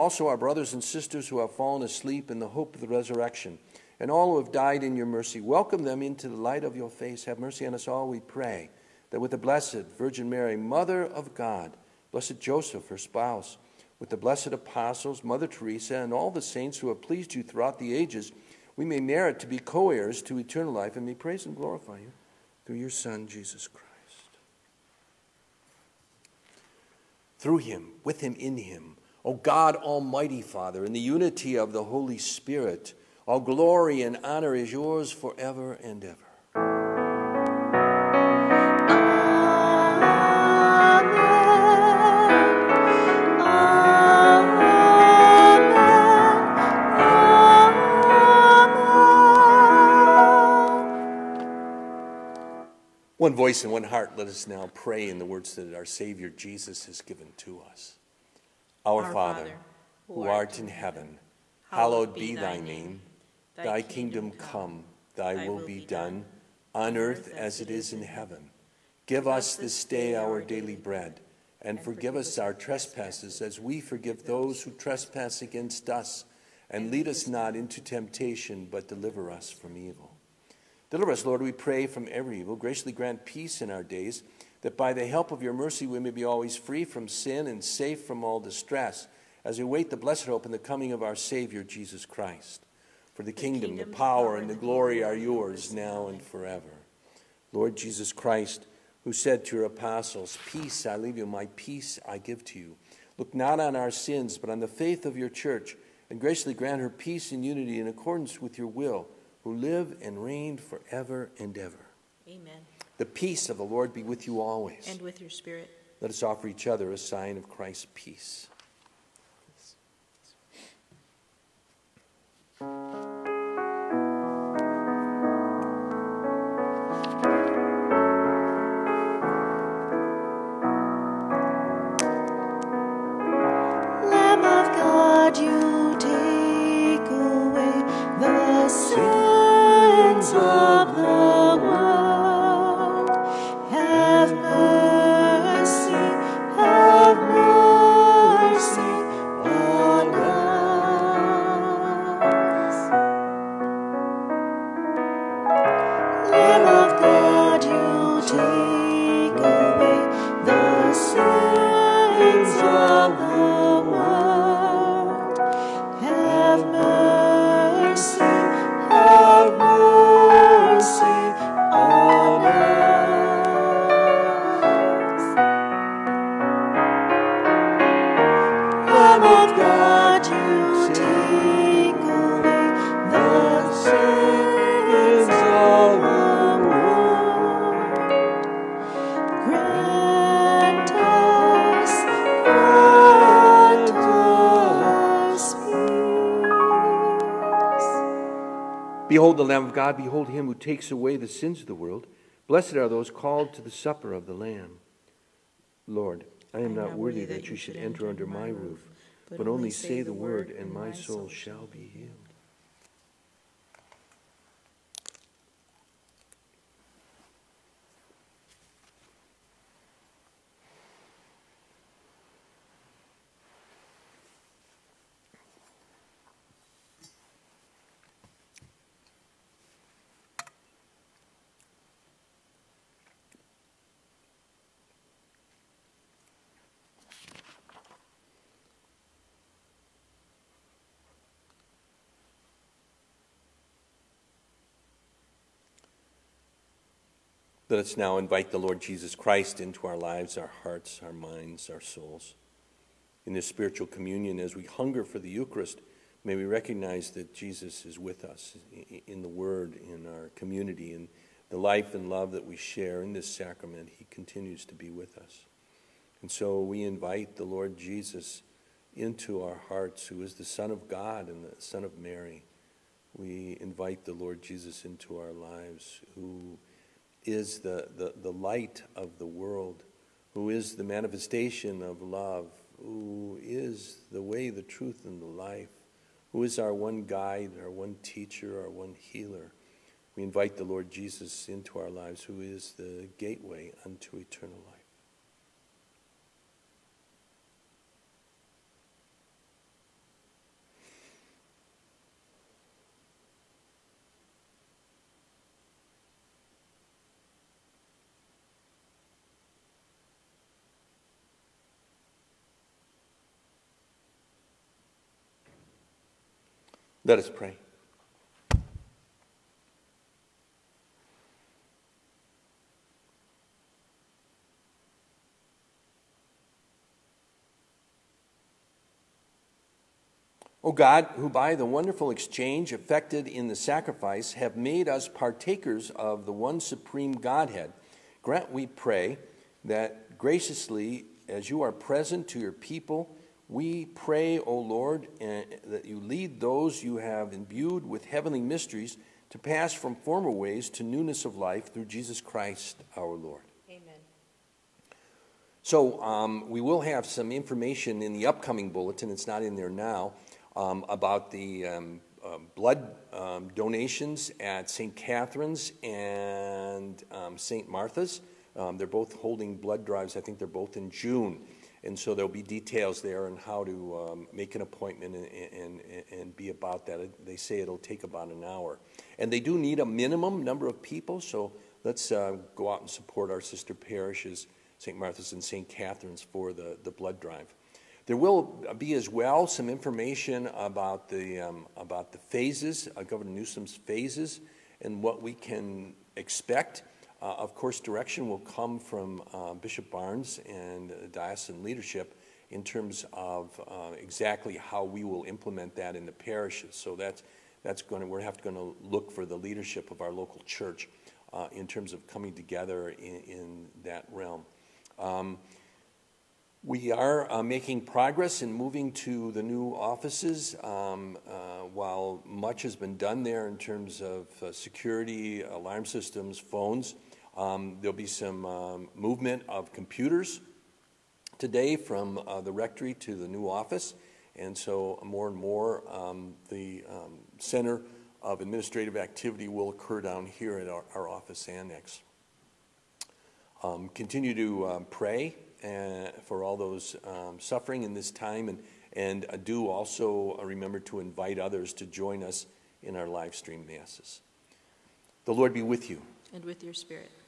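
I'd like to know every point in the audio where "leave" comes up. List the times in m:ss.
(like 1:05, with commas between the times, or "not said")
1:40.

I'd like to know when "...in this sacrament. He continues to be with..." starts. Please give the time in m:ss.
4:23.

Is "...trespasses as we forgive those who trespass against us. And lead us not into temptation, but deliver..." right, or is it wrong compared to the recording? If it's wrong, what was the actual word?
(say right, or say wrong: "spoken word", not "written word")
right.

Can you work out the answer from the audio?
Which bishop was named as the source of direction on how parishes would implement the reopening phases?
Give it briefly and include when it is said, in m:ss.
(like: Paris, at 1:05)
Bishop Barnes, at 6:39.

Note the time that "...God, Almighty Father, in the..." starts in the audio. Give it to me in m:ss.
0:29.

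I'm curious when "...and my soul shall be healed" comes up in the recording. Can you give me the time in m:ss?
3:30.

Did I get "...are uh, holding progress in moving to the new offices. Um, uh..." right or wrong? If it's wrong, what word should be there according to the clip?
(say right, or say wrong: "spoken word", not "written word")
wrong: "making", not "holding".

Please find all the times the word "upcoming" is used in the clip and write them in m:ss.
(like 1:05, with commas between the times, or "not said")
5:58.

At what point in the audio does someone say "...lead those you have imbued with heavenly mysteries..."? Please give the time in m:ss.
5:46.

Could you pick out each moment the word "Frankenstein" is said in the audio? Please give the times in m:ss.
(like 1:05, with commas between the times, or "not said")
not said.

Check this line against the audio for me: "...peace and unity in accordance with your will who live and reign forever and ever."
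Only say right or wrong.
right.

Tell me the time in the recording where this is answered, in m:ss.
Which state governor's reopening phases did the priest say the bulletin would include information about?
6:33.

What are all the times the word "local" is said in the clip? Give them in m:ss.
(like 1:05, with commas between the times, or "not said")
6:50.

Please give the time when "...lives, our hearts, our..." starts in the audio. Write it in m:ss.
4:09.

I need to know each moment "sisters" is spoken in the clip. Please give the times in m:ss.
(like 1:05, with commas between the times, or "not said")
0:00, 6:23.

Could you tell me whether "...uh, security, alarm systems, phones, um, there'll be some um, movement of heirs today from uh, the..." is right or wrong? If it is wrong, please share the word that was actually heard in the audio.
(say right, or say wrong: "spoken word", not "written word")
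wrong: "computers", not "heirs".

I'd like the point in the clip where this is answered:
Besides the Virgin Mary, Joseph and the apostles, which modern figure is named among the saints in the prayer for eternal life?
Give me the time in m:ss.
0:15.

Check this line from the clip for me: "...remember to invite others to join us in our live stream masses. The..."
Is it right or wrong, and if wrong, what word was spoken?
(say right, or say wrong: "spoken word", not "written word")
right.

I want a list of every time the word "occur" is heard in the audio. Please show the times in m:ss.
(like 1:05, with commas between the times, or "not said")
7:19.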